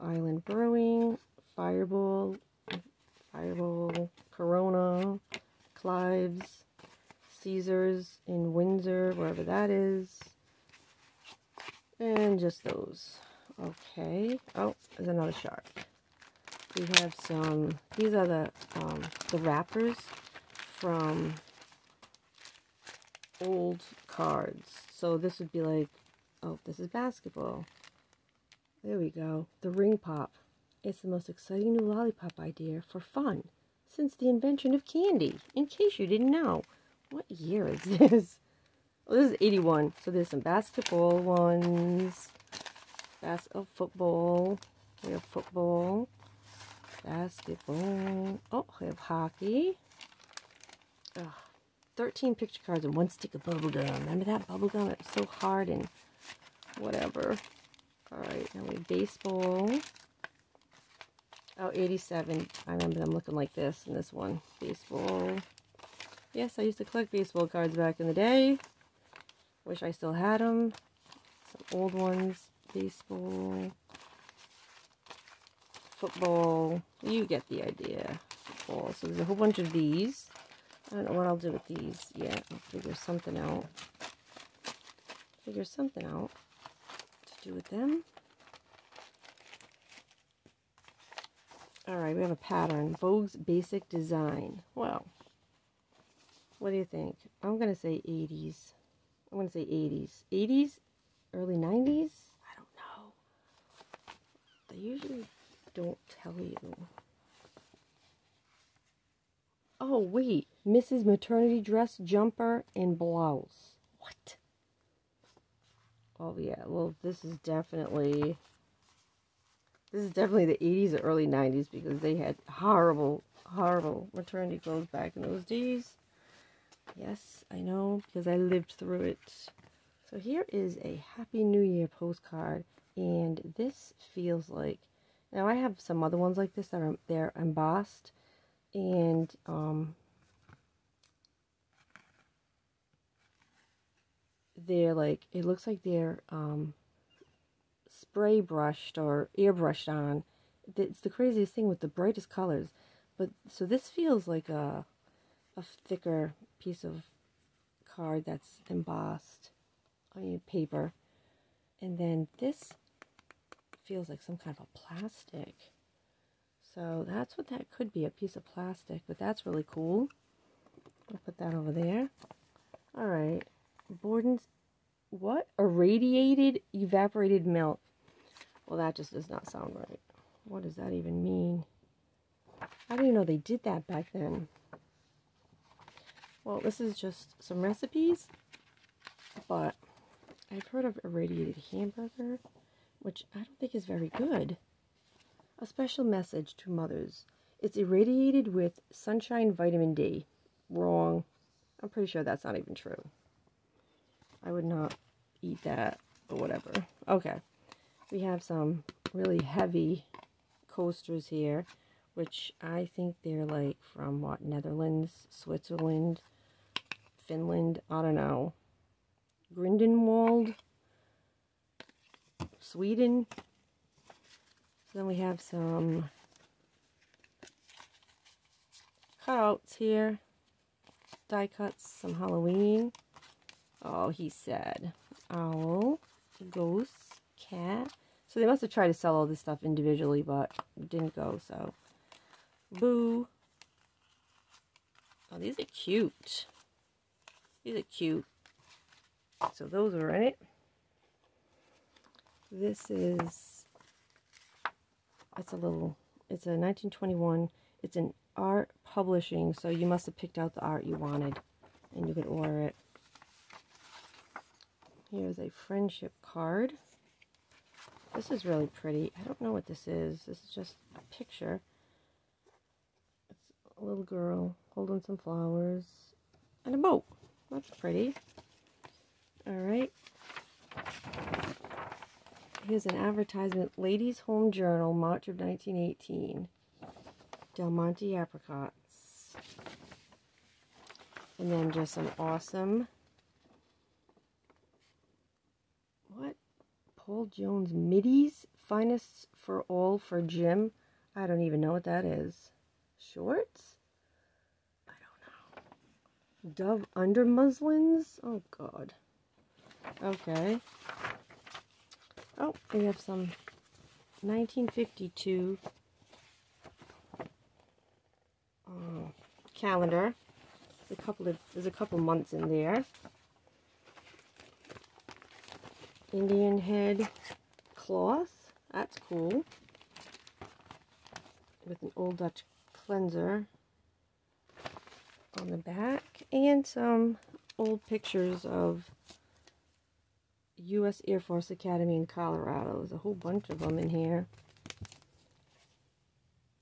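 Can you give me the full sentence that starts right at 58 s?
All right, now we have baseball.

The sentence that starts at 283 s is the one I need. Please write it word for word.
Ladies' Home Journal, March of 1918.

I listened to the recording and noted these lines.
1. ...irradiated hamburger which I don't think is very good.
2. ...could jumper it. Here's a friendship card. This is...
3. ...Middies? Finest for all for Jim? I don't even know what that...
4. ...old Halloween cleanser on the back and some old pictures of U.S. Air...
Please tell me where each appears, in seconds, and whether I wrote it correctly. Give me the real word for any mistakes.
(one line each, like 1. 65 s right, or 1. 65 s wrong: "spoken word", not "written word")
1. 191 s right
2. 262 s wrong: "order", not "jumper"
3. 297 s right
4. 331 s wrong: "Dutch", not "Halloween".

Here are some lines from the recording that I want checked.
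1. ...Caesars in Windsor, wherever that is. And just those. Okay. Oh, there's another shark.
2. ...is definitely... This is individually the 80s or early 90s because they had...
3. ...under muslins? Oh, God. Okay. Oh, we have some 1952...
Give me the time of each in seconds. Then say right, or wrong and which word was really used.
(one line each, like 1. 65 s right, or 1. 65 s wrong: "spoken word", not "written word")
1. 7 s right
2. 117 s wrong: "definitely", not "individually"
3. 306 s right.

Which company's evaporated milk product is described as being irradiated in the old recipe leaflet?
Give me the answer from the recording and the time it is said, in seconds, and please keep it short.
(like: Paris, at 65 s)
Borden's, at 173 s.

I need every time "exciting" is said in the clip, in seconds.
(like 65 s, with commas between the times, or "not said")
31 s.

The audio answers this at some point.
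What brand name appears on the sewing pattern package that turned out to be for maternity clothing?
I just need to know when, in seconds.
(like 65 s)
92 s.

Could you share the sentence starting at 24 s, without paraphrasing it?
So this would be like, oh, this is basketball.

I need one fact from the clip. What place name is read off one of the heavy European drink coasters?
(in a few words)
Grindelwald.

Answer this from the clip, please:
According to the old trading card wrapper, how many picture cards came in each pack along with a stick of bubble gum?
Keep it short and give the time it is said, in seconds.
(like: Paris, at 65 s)
13, at 51 s.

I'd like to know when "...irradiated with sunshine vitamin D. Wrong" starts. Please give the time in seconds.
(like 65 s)
197 s.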